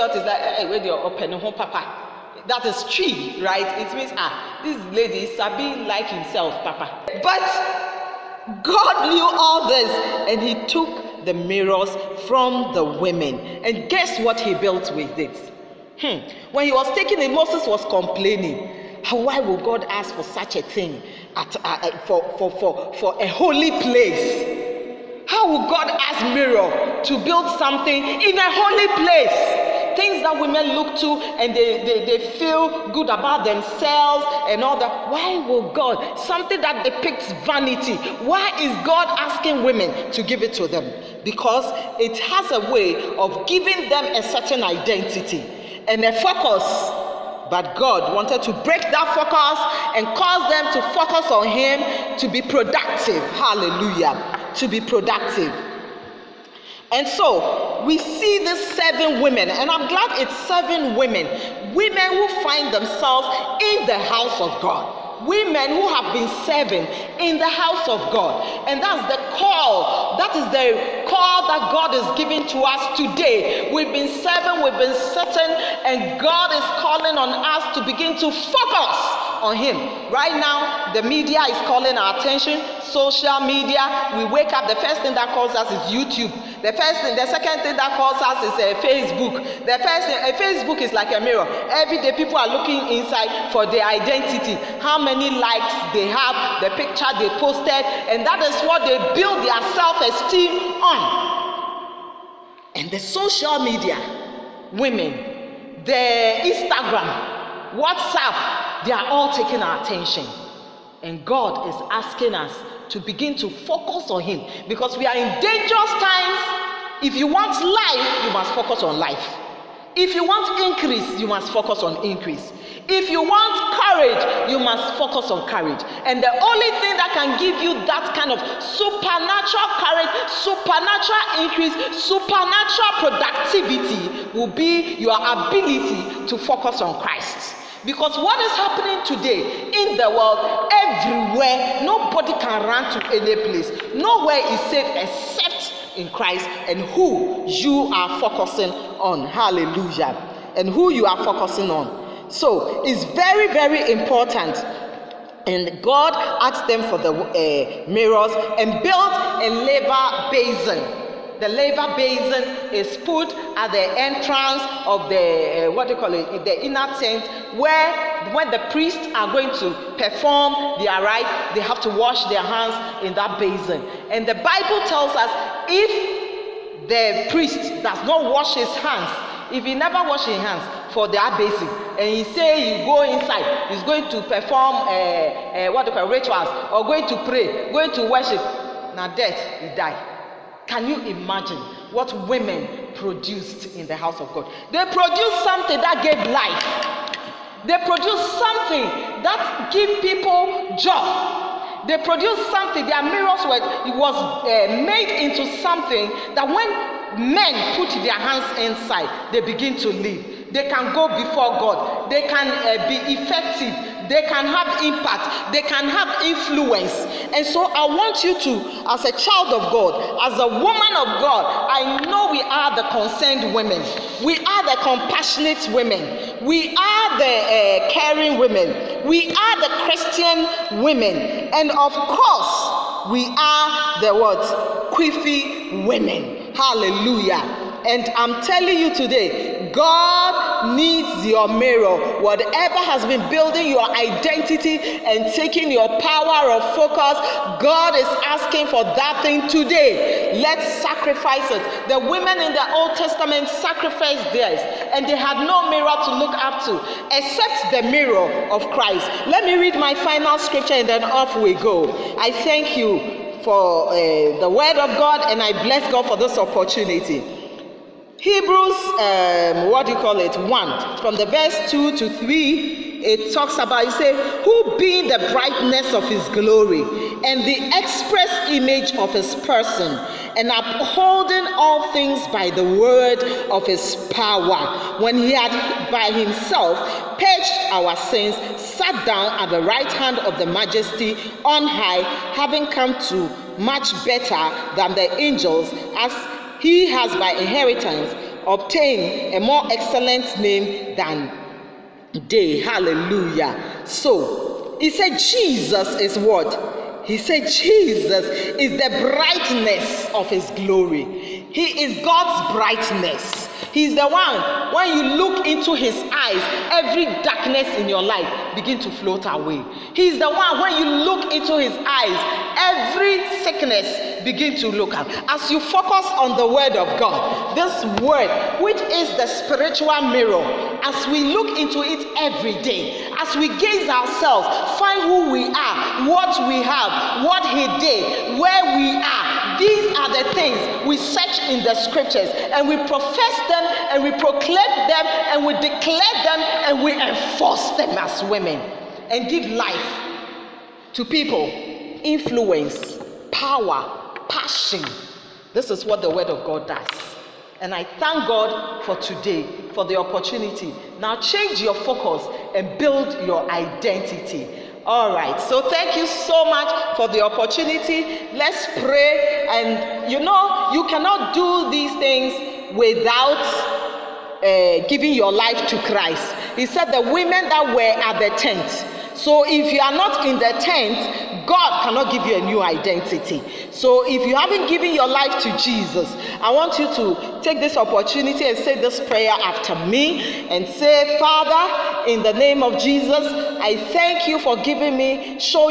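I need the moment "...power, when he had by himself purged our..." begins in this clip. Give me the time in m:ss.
4:44.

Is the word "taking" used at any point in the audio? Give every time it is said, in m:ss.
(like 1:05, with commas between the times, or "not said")
0:16, 1:49, 4:05.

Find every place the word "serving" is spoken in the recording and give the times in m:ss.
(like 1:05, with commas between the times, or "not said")
1:06, 1:14.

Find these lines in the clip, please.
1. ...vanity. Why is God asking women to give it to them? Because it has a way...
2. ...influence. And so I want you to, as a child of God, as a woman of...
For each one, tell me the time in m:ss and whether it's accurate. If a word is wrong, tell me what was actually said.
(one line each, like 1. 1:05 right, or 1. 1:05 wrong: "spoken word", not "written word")
1. 0:37 right
2. 3:36 right.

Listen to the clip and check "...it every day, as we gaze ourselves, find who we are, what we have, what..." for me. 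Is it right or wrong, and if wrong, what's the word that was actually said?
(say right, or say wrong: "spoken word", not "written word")
right.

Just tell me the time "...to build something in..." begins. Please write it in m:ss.
0:27.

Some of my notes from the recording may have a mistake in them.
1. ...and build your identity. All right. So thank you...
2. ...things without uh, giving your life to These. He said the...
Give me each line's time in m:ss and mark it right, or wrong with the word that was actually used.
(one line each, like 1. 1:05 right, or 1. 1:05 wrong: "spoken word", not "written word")
1. 6:02 right
2. 6:11 wrong: "Christ", not "These".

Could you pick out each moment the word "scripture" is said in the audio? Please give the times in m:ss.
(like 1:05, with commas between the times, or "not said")
4:20, 5:41.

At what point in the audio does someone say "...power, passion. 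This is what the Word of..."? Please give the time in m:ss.
5:53.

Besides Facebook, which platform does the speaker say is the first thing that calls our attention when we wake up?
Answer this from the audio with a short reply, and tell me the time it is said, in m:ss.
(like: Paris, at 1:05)
YouTube, at 1:25.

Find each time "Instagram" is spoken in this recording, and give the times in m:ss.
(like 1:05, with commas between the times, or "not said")
1:46.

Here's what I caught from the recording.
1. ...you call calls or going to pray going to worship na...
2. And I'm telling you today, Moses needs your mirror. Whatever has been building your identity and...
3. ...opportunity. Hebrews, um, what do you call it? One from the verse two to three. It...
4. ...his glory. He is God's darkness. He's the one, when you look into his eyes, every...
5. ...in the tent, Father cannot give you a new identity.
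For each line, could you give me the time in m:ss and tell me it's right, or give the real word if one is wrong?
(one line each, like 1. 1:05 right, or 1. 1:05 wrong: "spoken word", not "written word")
1. 3:05 wrong: "rituals", not "calls"
2. 3:57 wrong: "God", not "Moses"
3. 4:26 right
4. 5:10 wrong: "brightness", not "darkness"
5. 6:20 wrong: "God", not "Father".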